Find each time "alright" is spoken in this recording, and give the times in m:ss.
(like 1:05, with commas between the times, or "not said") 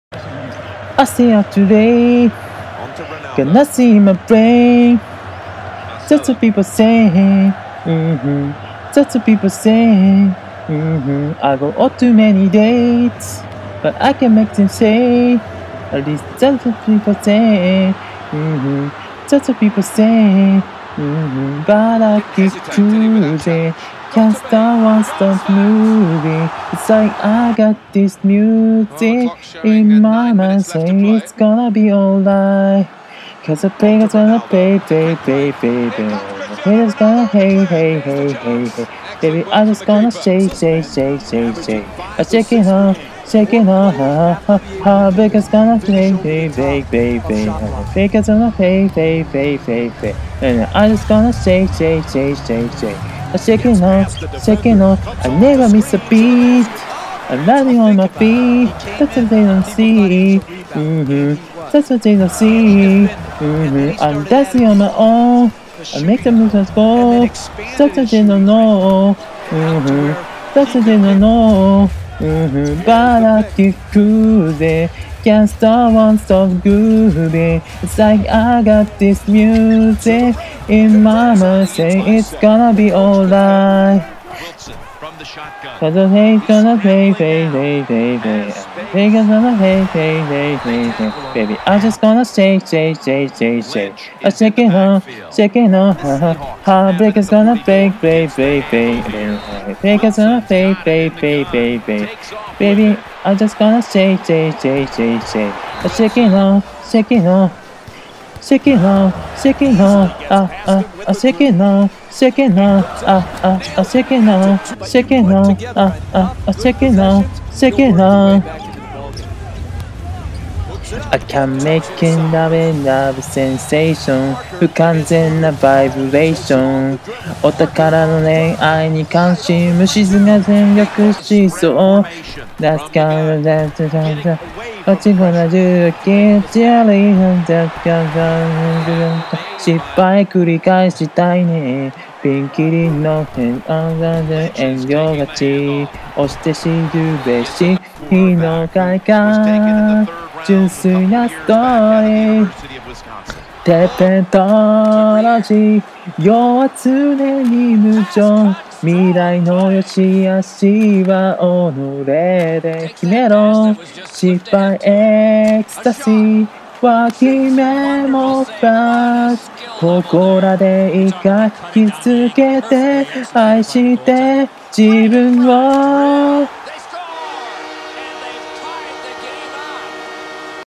0:31, 1:22.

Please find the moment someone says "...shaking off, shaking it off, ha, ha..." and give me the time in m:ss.
0:42.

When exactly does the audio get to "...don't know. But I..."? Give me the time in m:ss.
1:10.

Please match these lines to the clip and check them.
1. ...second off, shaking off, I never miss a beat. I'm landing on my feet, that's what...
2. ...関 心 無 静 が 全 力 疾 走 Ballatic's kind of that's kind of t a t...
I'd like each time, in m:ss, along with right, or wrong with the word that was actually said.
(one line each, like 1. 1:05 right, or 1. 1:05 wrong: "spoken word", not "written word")
1. 0:53 right
2. 2:09 wrong: "That", not "Ballatic".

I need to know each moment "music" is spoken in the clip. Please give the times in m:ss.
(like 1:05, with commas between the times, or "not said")
0:28, 1:19.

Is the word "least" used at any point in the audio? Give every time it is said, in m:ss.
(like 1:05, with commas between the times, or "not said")
0:16.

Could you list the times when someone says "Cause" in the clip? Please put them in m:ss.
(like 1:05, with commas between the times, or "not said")
0:33, 1:25.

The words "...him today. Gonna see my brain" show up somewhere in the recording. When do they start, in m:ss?
0:01.